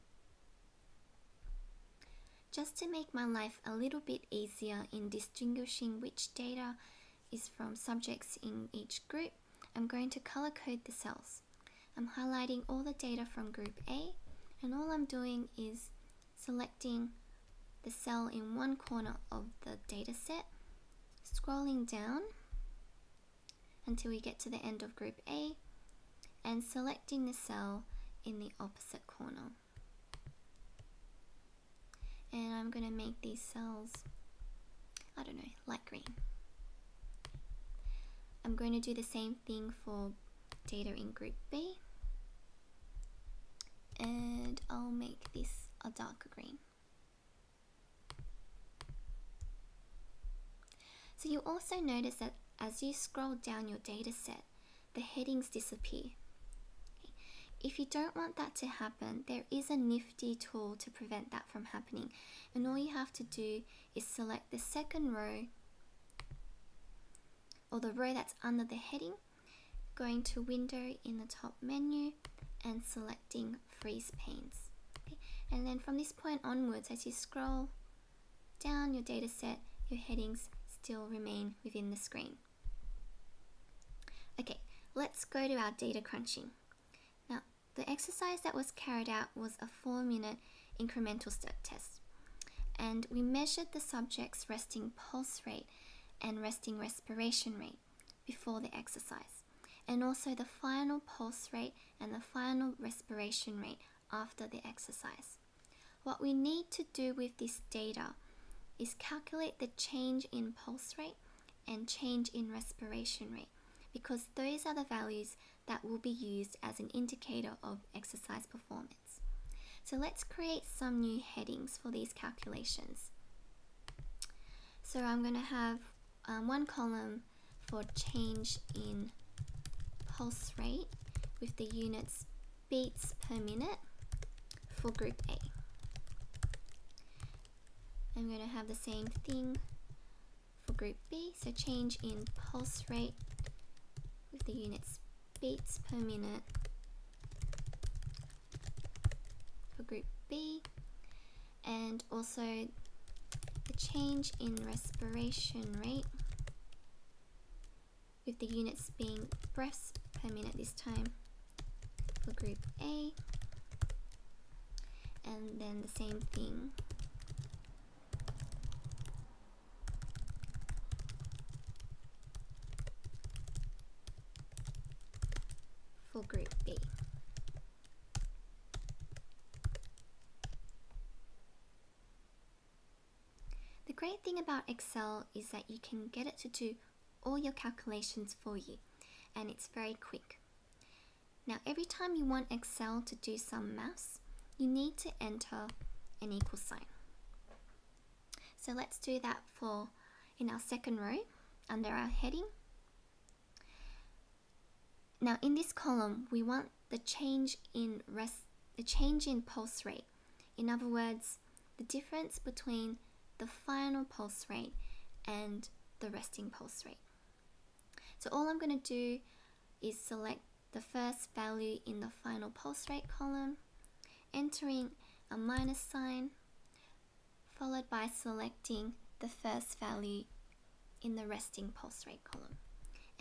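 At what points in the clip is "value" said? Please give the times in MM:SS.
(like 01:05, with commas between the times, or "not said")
01:54, 03:41, 03:49.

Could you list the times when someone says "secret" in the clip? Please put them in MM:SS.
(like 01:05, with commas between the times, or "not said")
not said.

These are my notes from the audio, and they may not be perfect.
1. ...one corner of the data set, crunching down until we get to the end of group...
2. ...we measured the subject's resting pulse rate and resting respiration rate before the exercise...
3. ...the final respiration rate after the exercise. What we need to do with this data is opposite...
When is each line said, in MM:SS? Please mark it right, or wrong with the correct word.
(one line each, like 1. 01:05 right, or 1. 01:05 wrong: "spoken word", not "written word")
1. 00:18 wrong: "scrolling", not "crunching"
2. 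01:33 right
3. 01:42 wrong: "calculate", not "opposite".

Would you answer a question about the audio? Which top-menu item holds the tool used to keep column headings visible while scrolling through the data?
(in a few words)
Window.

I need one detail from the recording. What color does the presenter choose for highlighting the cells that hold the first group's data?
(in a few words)
Light green.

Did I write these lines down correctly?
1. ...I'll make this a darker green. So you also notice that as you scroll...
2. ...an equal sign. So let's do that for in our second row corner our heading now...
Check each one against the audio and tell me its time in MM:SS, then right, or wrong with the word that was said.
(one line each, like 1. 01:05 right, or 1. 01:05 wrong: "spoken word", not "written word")
1. 00:44 right
2. 03:16 wrong: "under", not "corner".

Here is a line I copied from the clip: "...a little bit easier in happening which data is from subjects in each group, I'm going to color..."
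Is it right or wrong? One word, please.
wrong.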